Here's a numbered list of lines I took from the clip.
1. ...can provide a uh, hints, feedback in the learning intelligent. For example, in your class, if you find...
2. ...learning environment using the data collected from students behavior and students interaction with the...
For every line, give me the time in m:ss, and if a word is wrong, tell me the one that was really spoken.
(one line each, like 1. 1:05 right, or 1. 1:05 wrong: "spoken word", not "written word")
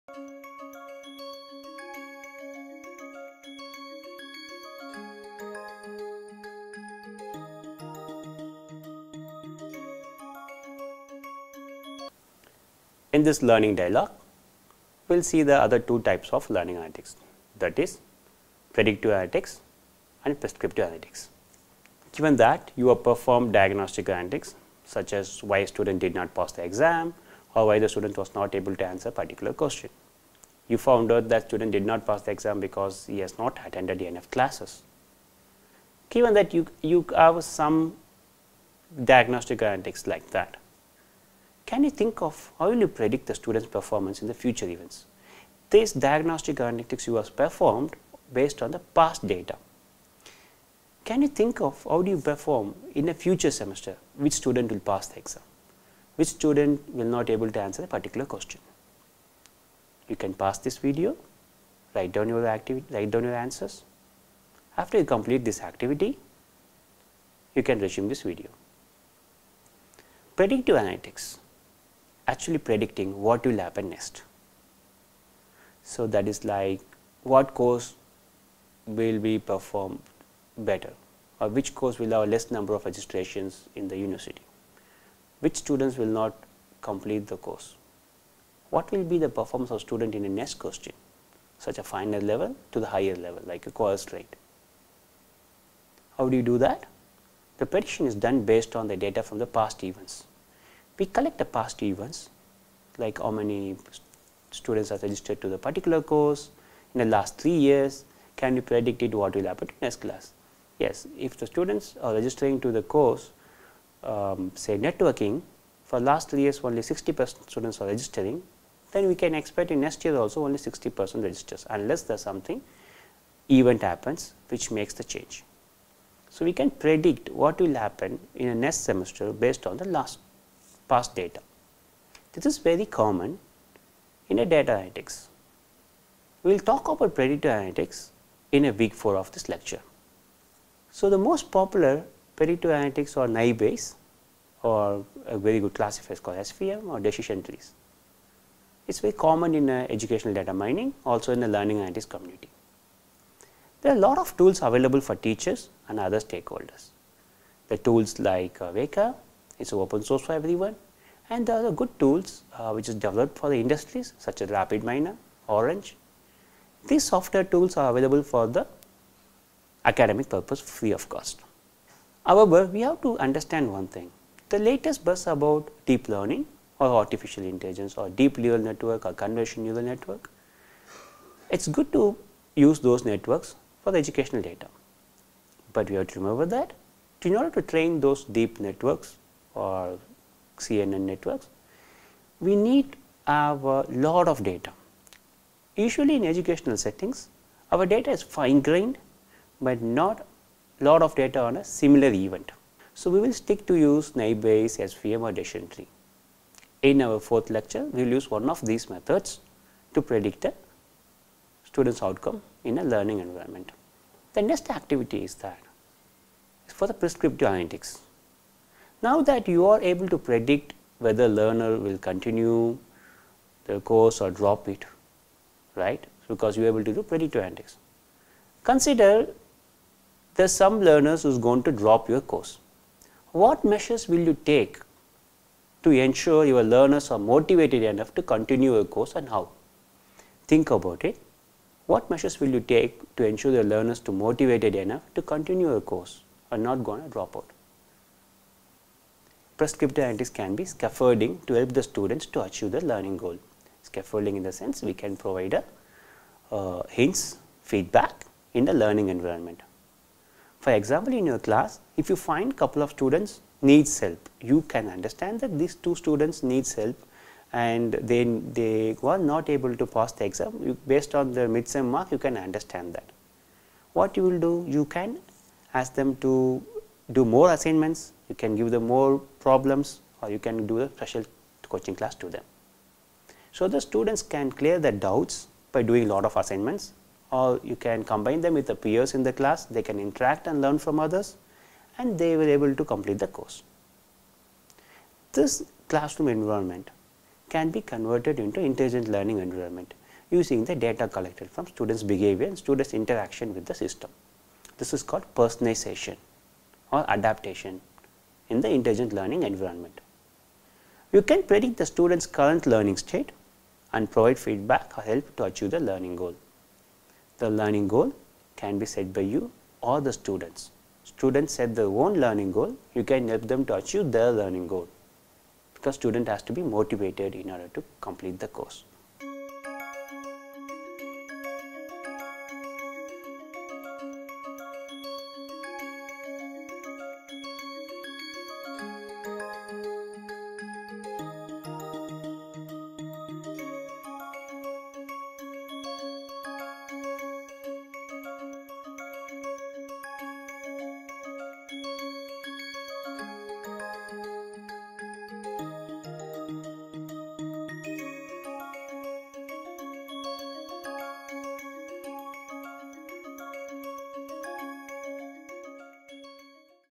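1. 4:14 wrong: "environment", not "intelligent"
2. 4:59 right.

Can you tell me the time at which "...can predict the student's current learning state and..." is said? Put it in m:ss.
5:11.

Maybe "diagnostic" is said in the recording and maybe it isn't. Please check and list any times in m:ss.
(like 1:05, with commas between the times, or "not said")
0:23, 0:39, 0:45.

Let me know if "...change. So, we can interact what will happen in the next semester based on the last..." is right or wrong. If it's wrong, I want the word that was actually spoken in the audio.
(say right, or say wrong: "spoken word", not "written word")
wrong: "predict", not "interact".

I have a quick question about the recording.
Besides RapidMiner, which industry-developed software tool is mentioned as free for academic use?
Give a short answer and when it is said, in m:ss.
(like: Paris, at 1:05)
Orange, at 2:45.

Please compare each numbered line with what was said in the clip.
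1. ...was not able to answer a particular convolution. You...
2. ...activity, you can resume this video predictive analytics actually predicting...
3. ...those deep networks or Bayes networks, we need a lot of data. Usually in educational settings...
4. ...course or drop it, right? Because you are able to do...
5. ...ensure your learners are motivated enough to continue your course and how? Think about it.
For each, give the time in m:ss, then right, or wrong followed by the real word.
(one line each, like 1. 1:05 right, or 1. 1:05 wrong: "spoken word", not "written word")
1. 0:28 wrong: "question", not "convolution"
2. 1:05 right
3. 3:07 wrong: "CNN", not "Bayes"
4. 3:43 right
5. 3:55 right.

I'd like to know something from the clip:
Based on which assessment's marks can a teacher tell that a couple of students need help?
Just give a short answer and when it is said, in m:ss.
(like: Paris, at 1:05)
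midsem mark, at 4:31.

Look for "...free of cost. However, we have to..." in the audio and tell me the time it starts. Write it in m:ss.
2:50.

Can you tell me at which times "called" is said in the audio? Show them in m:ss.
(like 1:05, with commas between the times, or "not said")
2:26, 5:05.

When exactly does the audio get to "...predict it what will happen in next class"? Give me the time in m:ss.
1:48.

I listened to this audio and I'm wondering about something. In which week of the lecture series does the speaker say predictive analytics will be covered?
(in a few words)
week 4.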